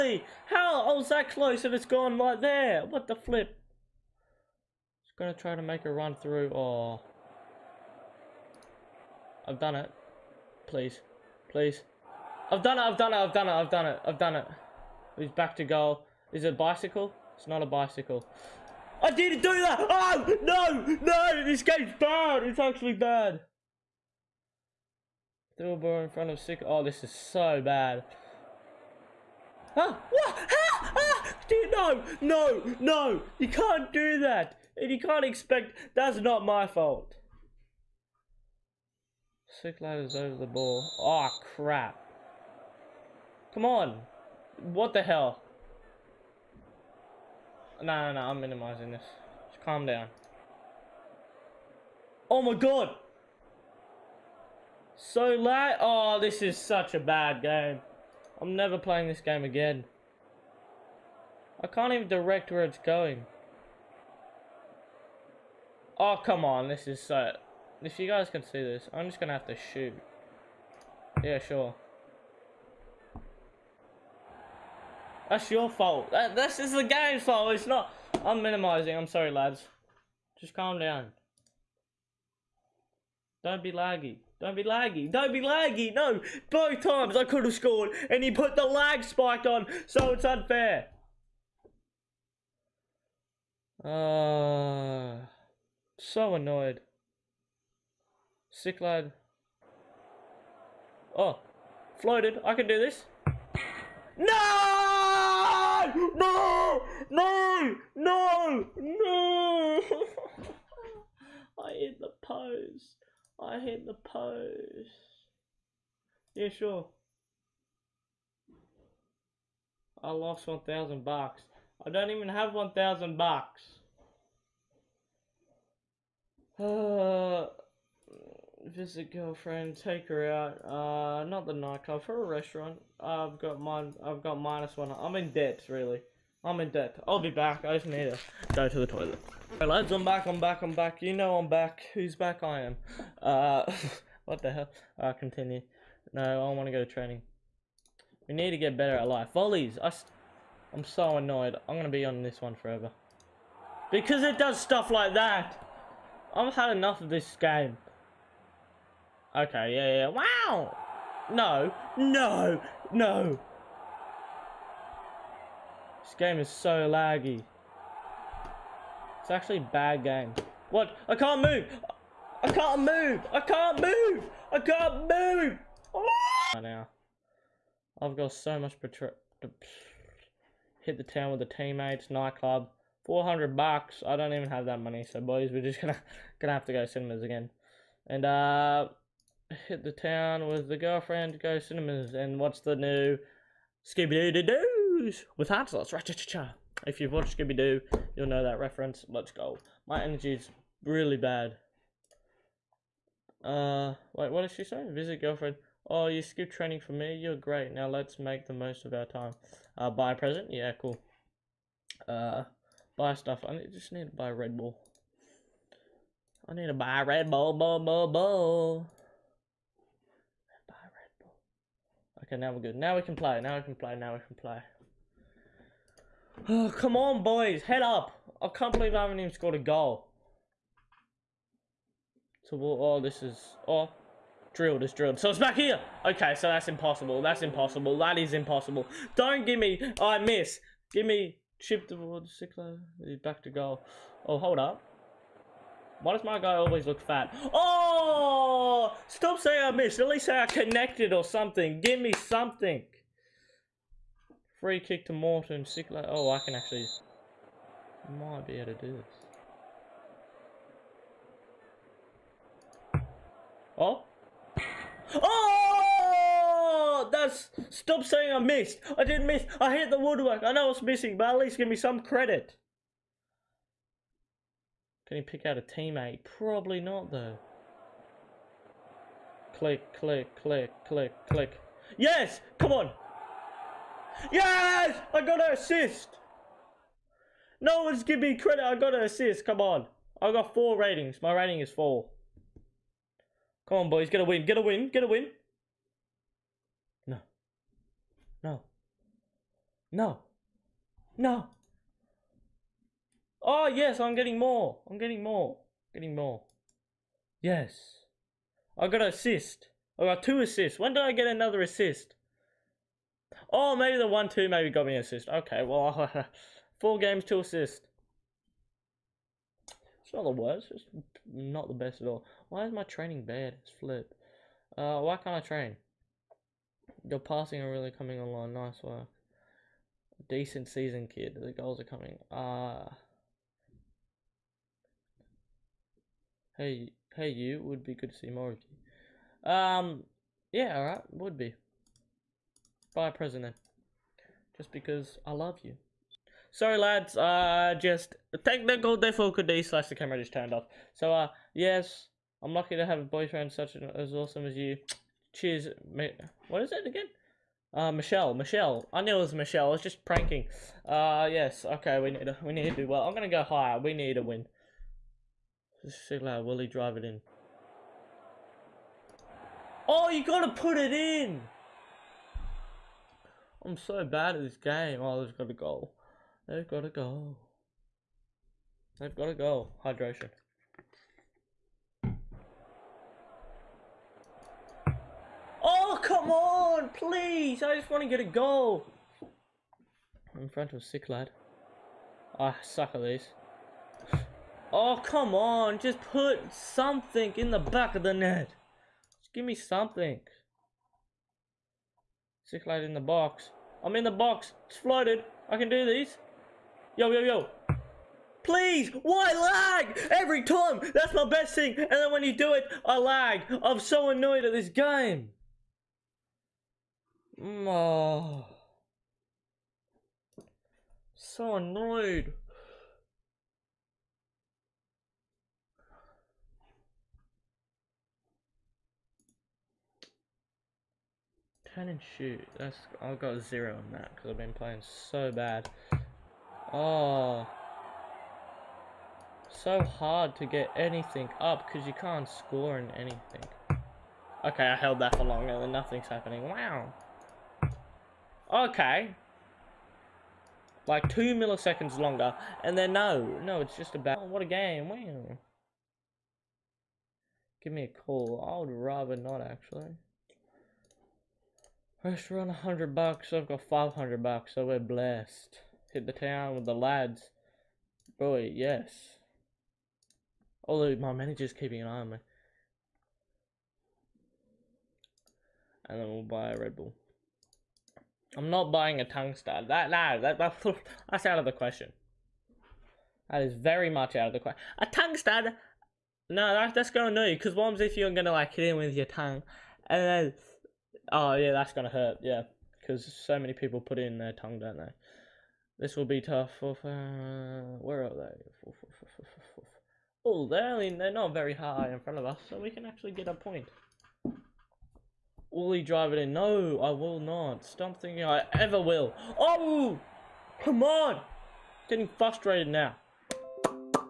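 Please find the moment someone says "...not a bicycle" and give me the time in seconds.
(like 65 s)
17 s.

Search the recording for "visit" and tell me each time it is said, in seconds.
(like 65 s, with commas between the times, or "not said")
128 s, 204 s.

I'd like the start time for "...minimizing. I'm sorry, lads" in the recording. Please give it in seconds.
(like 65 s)
78 s.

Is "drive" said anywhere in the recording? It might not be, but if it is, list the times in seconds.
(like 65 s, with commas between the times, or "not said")
366 s, 505 s.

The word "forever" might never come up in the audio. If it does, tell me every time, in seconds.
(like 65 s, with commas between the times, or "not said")
152 s.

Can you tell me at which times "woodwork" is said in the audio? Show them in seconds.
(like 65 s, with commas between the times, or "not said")
269 s.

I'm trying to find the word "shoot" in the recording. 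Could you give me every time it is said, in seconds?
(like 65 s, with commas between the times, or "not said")
69 s, 432 s.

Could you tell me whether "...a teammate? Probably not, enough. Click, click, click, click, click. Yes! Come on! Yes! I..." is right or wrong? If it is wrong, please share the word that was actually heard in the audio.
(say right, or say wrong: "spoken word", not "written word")
wrong: "though", not "enough".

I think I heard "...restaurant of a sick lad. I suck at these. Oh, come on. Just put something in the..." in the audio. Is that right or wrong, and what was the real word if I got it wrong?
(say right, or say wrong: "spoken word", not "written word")
wrong: "front", not "restaurant".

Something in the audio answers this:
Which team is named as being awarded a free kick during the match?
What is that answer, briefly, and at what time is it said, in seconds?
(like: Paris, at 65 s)
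Morton, at 255 s.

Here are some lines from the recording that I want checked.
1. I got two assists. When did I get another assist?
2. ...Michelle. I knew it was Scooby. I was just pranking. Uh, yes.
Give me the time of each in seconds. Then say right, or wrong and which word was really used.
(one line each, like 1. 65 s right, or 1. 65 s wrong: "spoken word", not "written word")
1. 309 s right
2. 358 s wrong: "Michelle", not "Scooby".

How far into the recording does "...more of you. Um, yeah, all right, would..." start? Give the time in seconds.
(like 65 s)
338 s.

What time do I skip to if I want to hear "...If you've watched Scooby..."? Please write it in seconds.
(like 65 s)
196 s.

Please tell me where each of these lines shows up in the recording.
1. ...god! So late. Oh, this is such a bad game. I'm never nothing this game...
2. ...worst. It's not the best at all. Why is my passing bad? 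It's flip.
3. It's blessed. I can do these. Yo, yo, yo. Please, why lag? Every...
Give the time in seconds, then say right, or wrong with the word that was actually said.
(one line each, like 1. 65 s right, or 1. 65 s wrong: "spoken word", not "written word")
1. 52 s wrong: "playing", not "nothing"
2. 320 s wrong: "training", not "passing"
3. 404 s wrong: "flooded", not "blessed".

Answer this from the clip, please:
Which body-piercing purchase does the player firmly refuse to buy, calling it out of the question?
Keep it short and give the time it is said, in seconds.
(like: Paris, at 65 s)
tongue stud, at 484 s.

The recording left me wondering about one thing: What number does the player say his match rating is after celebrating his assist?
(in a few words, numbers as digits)
4.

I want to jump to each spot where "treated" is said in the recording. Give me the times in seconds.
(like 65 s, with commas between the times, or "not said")
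not said.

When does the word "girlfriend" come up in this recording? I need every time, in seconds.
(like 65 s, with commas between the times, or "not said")
129 s, 190 s, 205 s.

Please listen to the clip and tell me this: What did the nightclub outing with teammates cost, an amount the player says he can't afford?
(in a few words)
400 bucks.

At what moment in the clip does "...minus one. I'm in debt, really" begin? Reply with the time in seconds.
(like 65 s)
134 s.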